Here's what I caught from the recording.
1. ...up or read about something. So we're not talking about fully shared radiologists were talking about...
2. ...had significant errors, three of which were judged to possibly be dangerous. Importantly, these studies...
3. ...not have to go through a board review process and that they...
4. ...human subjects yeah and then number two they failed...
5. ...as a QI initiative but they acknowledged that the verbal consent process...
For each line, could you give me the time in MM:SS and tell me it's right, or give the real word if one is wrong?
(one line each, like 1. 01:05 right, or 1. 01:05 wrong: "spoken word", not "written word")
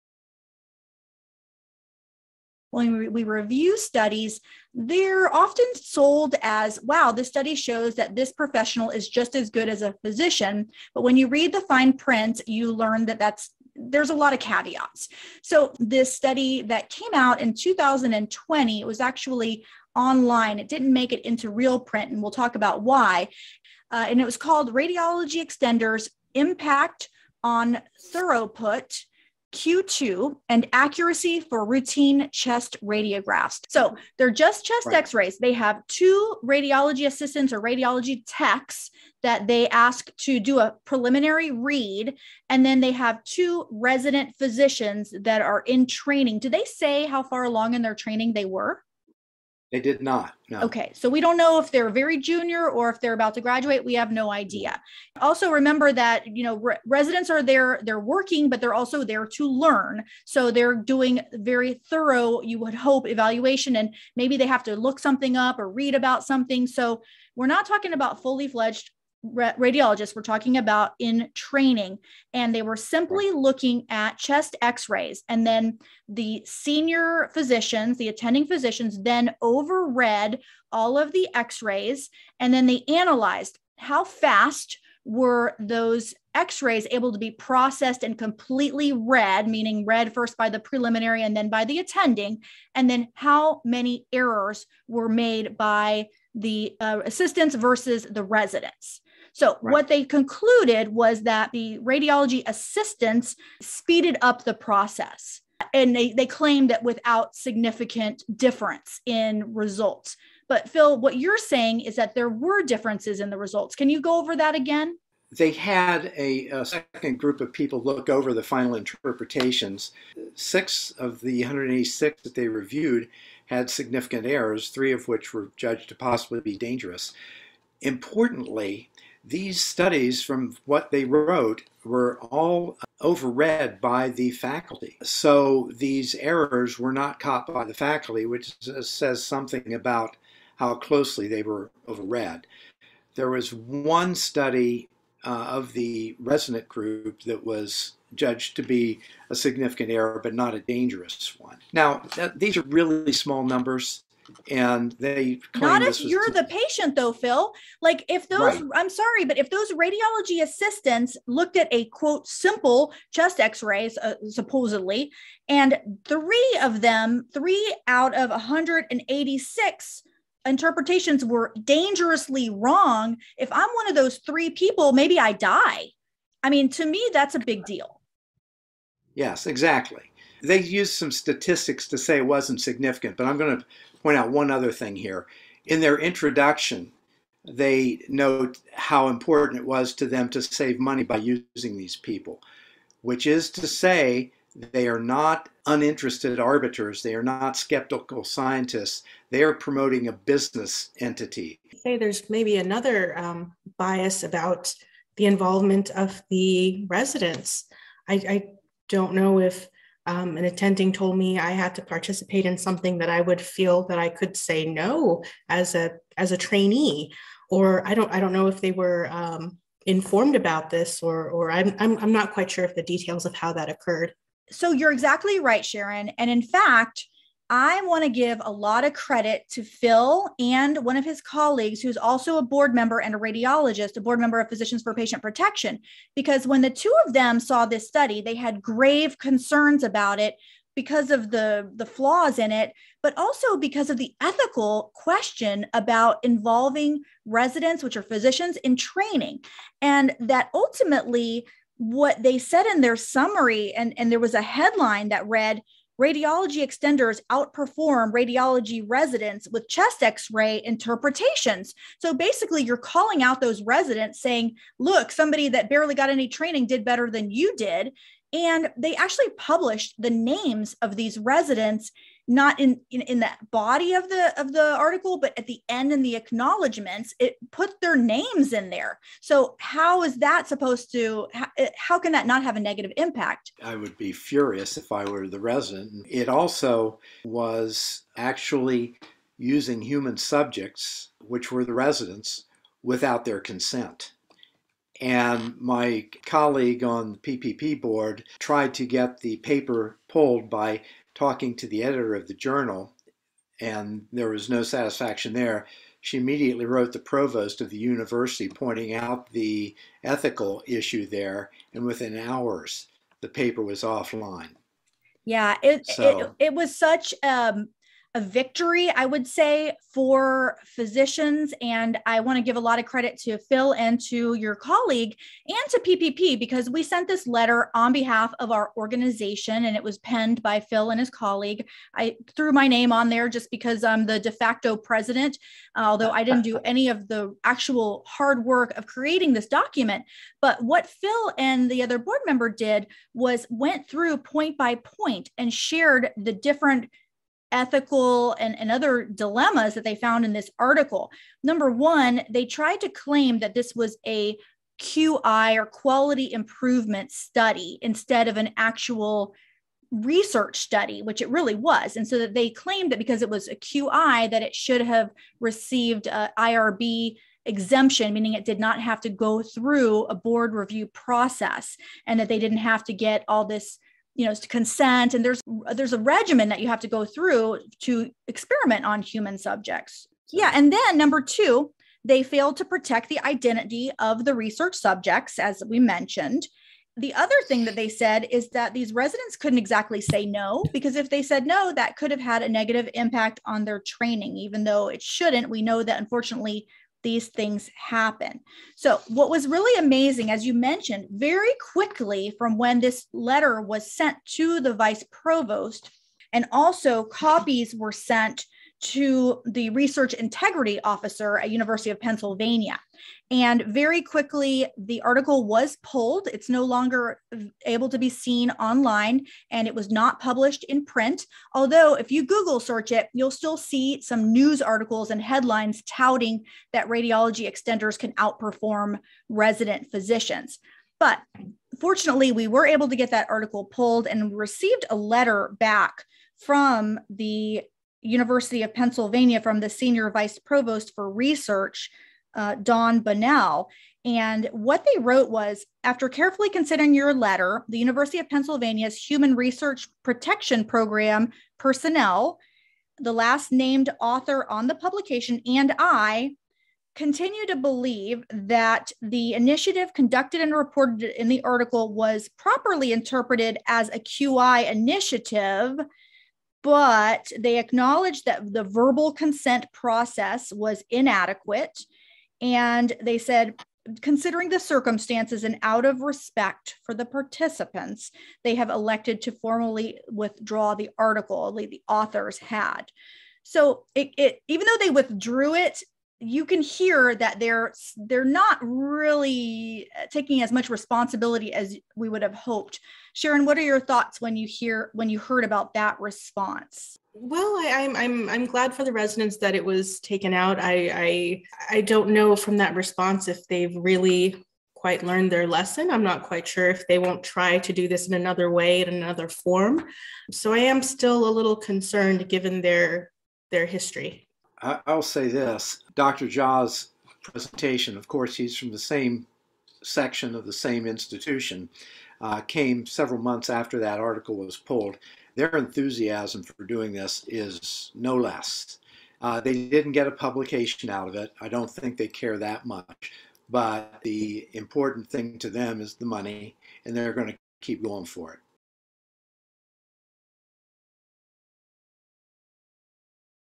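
1. 01:05 wrong: "fledged", not "shared"
2. 02:03 right
3. 06:08 right
4. 06:19 right
5. 07:43 right.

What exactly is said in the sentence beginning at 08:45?
Their enthusiasm for doing this is no less.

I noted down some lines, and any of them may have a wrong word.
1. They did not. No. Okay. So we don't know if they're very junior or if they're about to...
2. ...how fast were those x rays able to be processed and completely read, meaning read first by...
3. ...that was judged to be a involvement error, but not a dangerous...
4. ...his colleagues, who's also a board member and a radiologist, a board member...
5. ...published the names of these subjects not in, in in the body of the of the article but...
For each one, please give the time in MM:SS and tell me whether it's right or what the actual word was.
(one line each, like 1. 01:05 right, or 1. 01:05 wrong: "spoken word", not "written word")
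1. 00:49 right
2. 01:23 right
3. 02:27 wrong: "significant", not "involvement"
4. 03:51 right
5. 04:29 wrong: "residents", not "subjects".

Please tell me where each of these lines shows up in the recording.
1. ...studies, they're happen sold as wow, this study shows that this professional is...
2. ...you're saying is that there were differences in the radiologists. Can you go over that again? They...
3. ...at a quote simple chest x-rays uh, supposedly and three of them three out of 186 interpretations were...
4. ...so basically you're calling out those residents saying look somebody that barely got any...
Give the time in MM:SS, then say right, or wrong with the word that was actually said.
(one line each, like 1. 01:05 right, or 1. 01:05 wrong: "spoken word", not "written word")
1. 00:03 wrong: "often", not "happen"
2. 01:51 wrong: "results", not "radiologists"
3. 02:41 right
4. 04:22 right.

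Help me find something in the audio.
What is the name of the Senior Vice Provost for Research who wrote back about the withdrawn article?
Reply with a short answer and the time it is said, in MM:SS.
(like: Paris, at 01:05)
Dawn Bonnell, at 07:22.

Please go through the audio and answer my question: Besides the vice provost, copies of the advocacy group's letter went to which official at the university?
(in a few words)
research integrity officer.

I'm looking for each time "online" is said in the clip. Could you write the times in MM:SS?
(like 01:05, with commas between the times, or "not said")
00:19, 06:58.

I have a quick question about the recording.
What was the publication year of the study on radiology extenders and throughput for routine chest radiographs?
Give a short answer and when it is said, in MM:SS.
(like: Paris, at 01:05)
2020, at 00:17.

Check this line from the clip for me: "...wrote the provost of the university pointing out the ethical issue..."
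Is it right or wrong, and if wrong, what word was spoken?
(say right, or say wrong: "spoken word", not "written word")
right.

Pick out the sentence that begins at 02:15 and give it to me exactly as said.
So these errors were not caught by the faculty, which uh, says something about how closely they were overread.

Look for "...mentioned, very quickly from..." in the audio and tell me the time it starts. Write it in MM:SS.
06:40.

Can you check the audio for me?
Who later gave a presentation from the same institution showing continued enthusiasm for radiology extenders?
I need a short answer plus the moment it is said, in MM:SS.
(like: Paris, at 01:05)
Dr. Jha, at 08:35.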